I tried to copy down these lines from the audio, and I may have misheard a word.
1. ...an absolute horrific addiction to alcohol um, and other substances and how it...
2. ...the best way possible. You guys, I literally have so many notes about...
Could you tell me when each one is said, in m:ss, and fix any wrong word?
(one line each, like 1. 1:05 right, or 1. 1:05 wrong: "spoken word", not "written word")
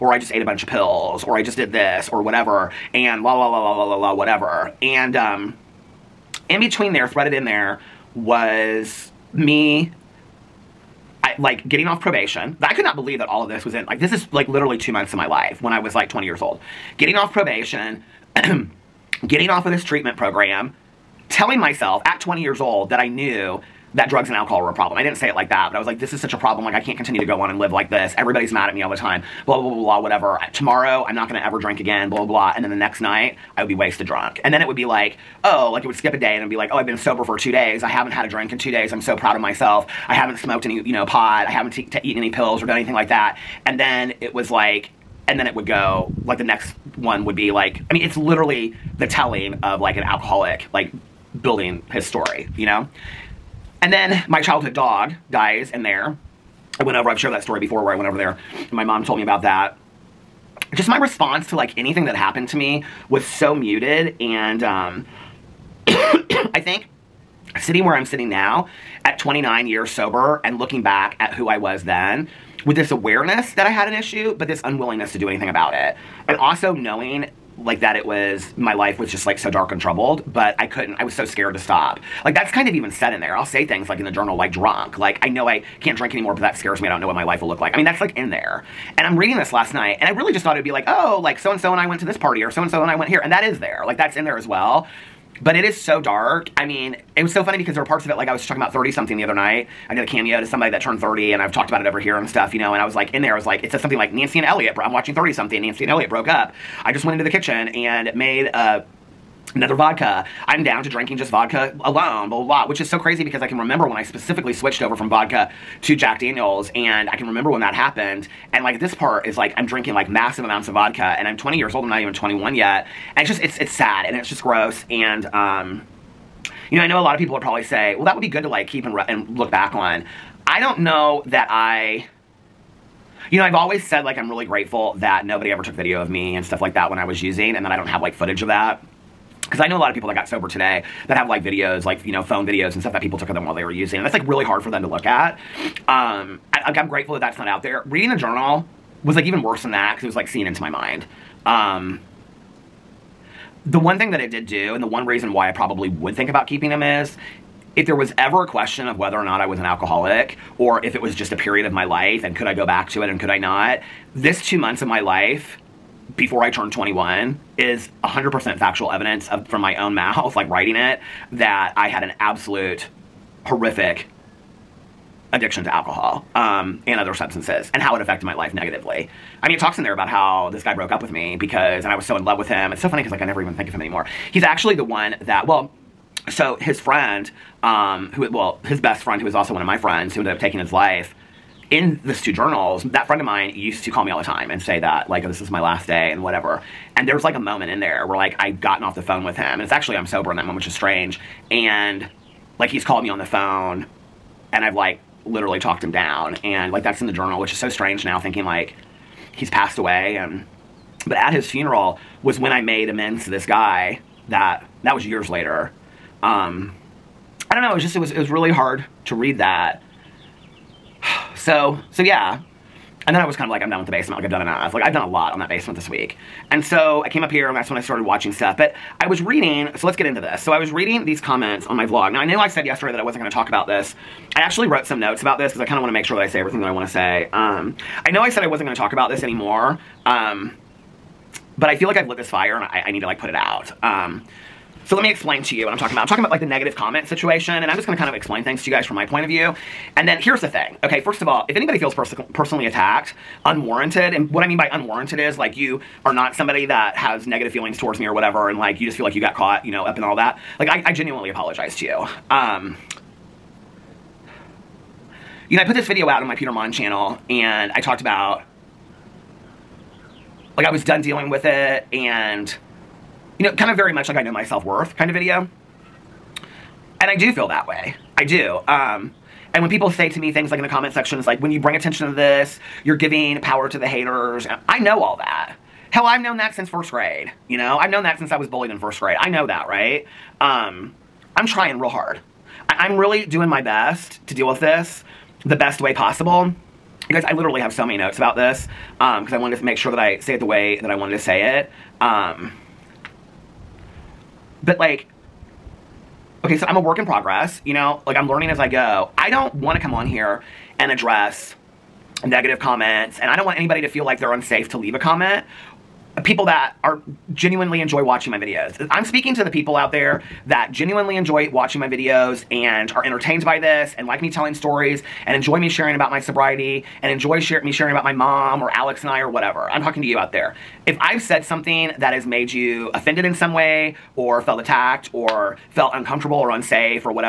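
1. 2:52 right
2. 4:55 right.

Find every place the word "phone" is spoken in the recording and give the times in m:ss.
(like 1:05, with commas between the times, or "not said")
2:22, 3:19, 3:23.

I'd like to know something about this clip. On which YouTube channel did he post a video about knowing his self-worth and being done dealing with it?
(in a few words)
Peter Monn.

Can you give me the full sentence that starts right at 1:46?
I just went into the kitchen and made a another vodka.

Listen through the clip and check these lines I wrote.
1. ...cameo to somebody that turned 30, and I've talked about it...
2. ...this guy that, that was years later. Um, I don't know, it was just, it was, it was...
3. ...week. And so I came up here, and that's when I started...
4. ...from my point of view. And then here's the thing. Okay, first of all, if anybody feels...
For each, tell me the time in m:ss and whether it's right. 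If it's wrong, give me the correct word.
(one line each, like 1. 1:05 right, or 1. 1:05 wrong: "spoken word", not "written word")
1. 1:40 right
2. 3:33 right
3. 3:45 right
4. 4:08 right.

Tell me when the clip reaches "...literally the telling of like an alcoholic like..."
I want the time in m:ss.
0:48.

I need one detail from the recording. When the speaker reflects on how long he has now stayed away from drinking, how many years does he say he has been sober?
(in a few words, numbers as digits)
29.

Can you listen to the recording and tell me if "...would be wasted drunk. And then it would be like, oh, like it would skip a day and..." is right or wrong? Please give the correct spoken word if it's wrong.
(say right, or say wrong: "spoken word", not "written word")
right.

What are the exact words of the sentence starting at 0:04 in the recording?
And, um, in between there, threaded in there, was me I, like getting off probation.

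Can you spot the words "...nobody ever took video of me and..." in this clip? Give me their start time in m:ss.
2:15.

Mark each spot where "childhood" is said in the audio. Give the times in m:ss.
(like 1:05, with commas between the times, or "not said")
0:54.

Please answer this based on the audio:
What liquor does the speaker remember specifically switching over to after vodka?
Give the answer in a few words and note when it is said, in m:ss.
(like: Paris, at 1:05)
Jack Daniels, at 1:55.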